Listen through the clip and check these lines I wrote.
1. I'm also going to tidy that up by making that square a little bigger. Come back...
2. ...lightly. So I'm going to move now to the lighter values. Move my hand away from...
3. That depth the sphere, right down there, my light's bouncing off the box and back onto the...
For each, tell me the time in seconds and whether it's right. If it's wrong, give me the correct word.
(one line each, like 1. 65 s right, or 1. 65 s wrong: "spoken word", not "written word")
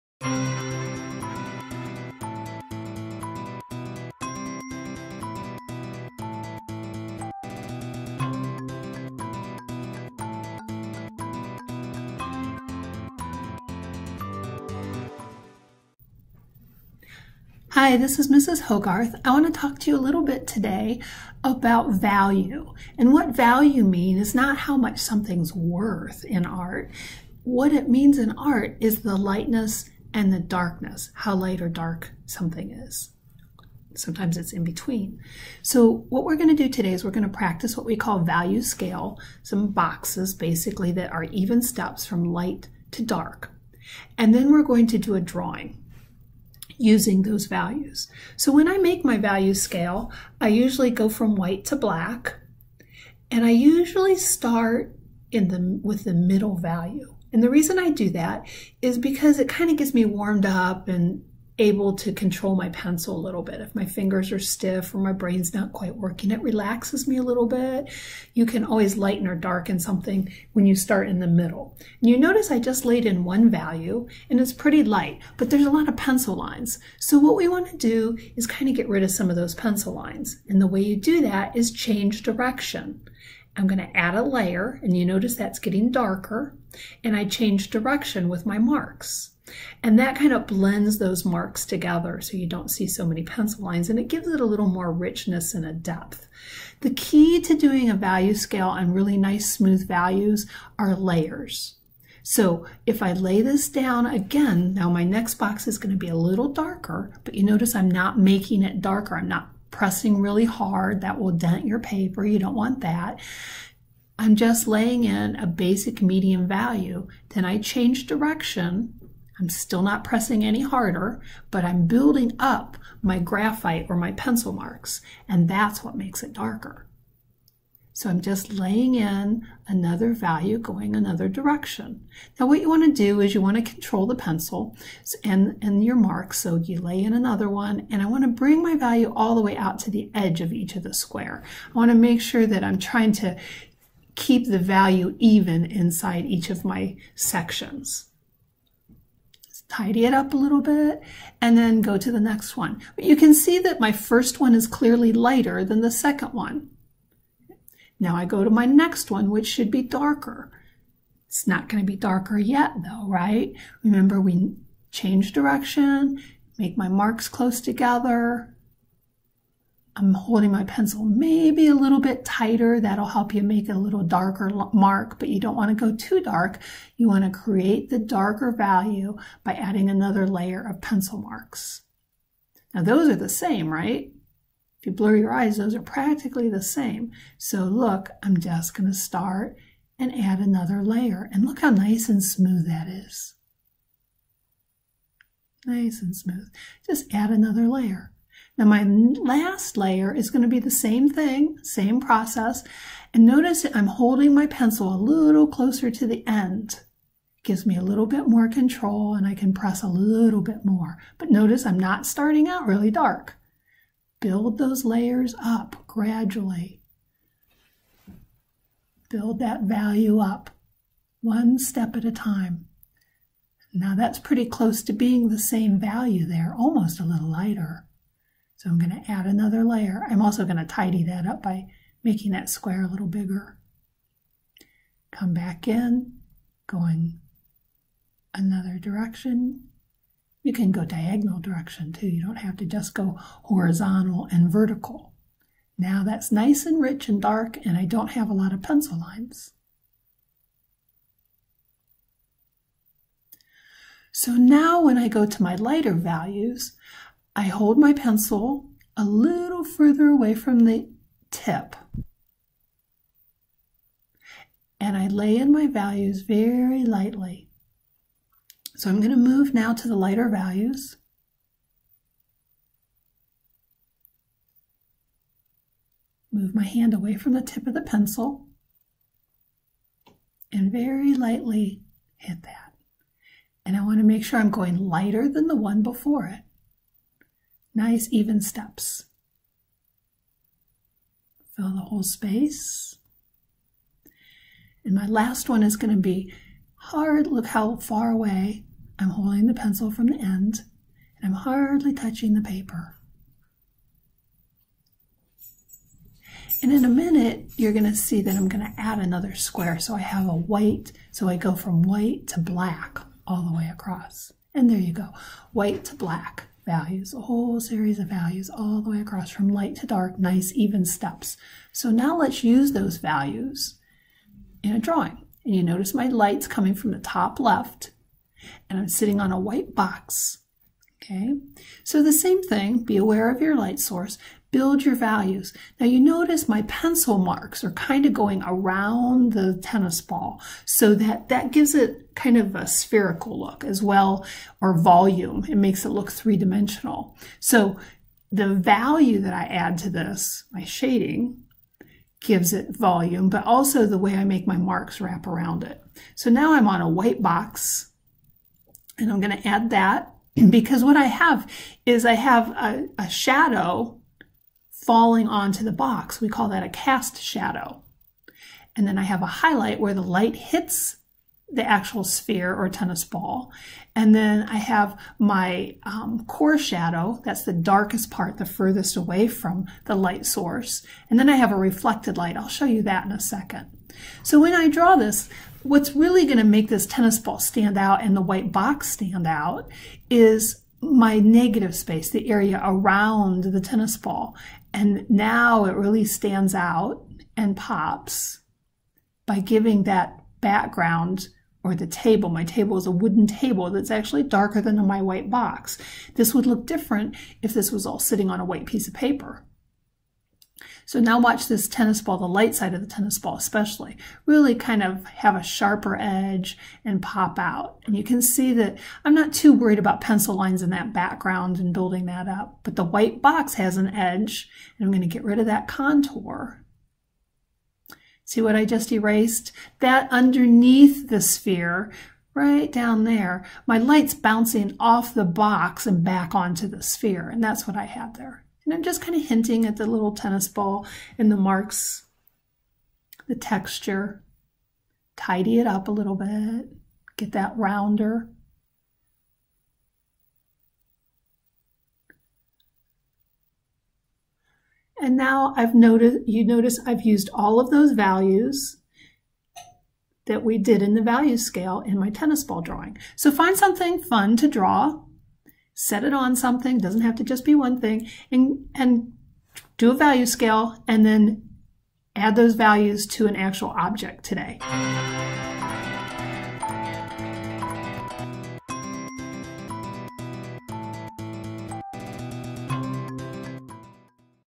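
1. 230 s right
2. 266 s right
3. 429 s wrong: "underneath", not "depth".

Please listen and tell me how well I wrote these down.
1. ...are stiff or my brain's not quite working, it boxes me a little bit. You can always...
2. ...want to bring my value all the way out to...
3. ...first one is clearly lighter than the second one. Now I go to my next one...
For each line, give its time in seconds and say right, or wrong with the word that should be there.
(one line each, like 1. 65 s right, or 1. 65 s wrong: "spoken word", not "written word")
1. 64 s wrong: "relaxes", not "boxes"
2. 138 s right
3. 153 s right.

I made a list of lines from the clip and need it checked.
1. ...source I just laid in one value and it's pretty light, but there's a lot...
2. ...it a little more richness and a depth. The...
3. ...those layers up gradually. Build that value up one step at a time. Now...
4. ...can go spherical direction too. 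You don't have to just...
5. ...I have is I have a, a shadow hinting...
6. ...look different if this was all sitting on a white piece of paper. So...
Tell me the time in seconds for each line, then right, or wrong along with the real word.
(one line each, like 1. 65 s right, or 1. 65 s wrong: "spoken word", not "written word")
1. 72 s wrong: "notice", not "source"
2. 94 s right
3. 214 s right
4. 240 s wrong: "diagonal", not "spherical"
5. 360 s wrong: "falling", not "hinting"
6. 406 s right.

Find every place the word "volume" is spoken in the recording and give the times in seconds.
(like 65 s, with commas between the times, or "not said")
344 s, 352 s.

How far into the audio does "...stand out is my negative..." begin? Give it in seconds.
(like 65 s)
388 s.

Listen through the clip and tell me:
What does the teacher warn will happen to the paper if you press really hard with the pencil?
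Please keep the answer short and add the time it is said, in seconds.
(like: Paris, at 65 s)
Dent your paper, at 111 s.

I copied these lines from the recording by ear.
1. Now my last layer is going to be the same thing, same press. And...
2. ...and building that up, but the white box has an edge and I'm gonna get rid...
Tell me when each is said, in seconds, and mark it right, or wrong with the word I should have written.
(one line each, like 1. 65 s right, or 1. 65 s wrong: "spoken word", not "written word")
1. 198 s wrong: "process", not "press"
2. 421 s right.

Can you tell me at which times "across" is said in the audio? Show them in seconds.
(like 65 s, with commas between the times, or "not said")
313 s, 319 s.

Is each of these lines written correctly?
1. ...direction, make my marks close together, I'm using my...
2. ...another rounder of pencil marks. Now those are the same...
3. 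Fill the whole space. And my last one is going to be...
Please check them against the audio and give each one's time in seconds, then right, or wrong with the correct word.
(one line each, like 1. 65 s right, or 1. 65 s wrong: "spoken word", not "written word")
1. 165 s wrong: "holding", not "using"
2. 179 s wrong: "layer", not "rounder"
3. 291 s right.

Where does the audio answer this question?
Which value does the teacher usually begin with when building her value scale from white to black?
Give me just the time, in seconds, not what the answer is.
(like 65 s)
56 s.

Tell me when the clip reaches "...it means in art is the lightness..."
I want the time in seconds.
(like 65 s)
27 s.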